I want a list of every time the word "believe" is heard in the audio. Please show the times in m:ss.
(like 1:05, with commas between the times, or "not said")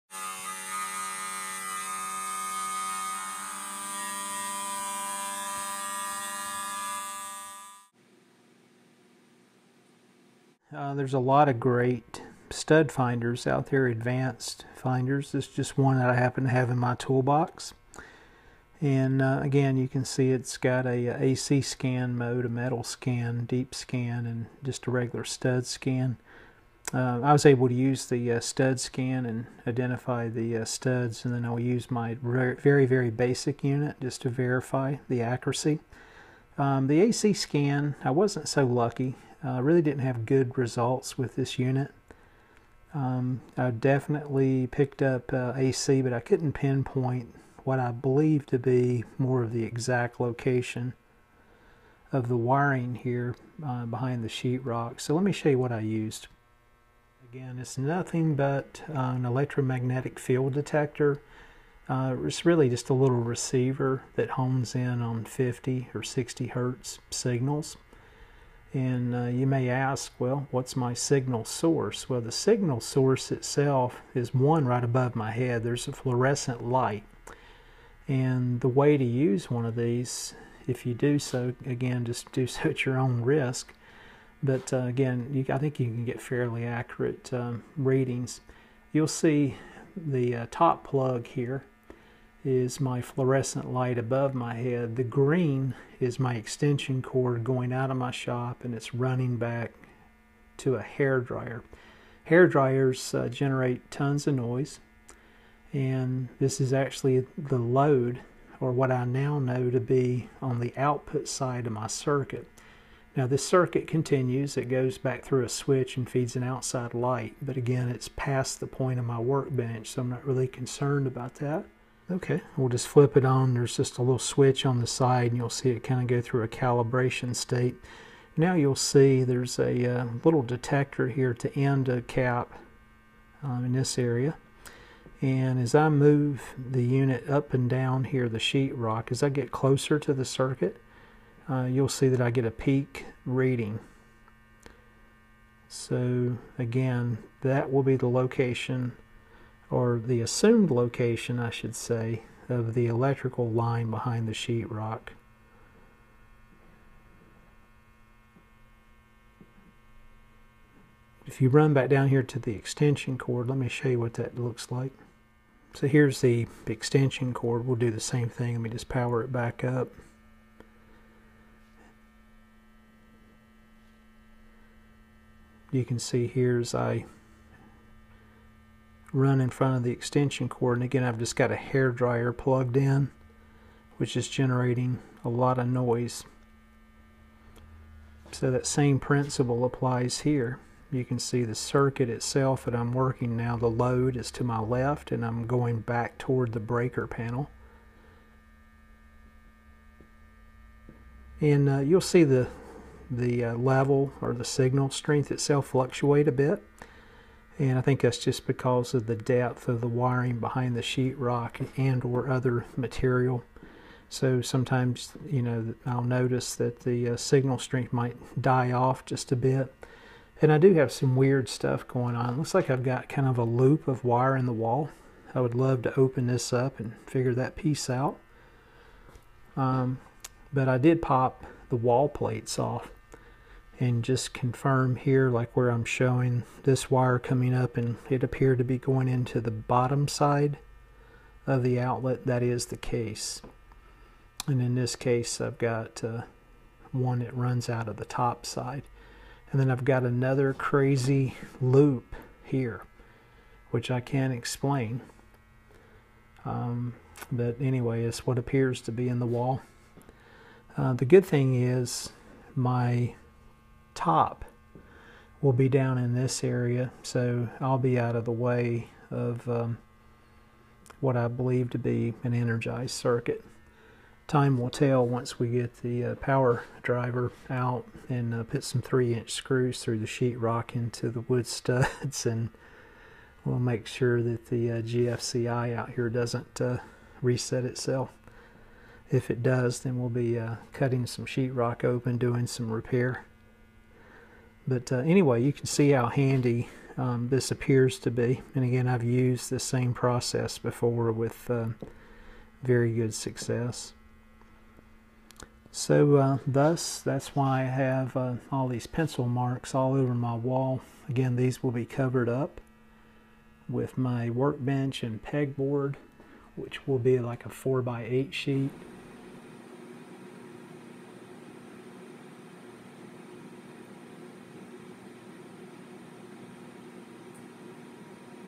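0:47, 4:31.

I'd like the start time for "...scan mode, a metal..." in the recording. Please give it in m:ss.
0:21.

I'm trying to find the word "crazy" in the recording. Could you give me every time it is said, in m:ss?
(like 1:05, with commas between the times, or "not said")
4:10.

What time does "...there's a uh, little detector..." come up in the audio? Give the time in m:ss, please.
2:09.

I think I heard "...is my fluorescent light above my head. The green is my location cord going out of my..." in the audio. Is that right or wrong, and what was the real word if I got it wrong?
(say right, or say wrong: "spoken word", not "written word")
wrong: "extension", not "location".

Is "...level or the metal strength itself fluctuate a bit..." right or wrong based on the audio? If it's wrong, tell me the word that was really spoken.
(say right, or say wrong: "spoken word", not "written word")
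wrong: "signal", not "metal".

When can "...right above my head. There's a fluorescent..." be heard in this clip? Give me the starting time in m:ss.
1:14.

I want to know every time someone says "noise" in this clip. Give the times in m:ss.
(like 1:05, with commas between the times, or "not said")
1:44, 3:05.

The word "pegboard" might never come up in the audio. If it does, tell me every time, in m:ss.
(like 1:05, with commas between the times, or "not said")
5:15.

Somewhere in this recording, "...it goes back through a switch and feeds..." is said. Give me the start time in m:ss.
1:54.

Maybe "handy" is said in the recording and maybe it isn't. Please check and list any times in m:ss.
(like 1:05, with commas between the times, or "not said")
4:56.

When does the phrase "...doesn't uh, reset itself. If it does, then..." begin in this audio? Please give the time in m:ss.
4:46.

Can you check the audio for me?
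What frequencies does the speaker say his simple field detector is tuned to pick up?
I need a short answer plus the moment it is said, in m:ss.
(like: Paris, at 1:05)
50 or 60 hertz, at 1:05.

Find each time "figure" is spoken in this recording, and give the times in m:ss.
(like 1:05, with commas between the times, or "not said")
3:47.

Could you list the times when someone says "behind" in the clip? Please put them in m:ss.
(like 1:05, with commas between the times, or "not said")
0:53, 2:33, 3:30.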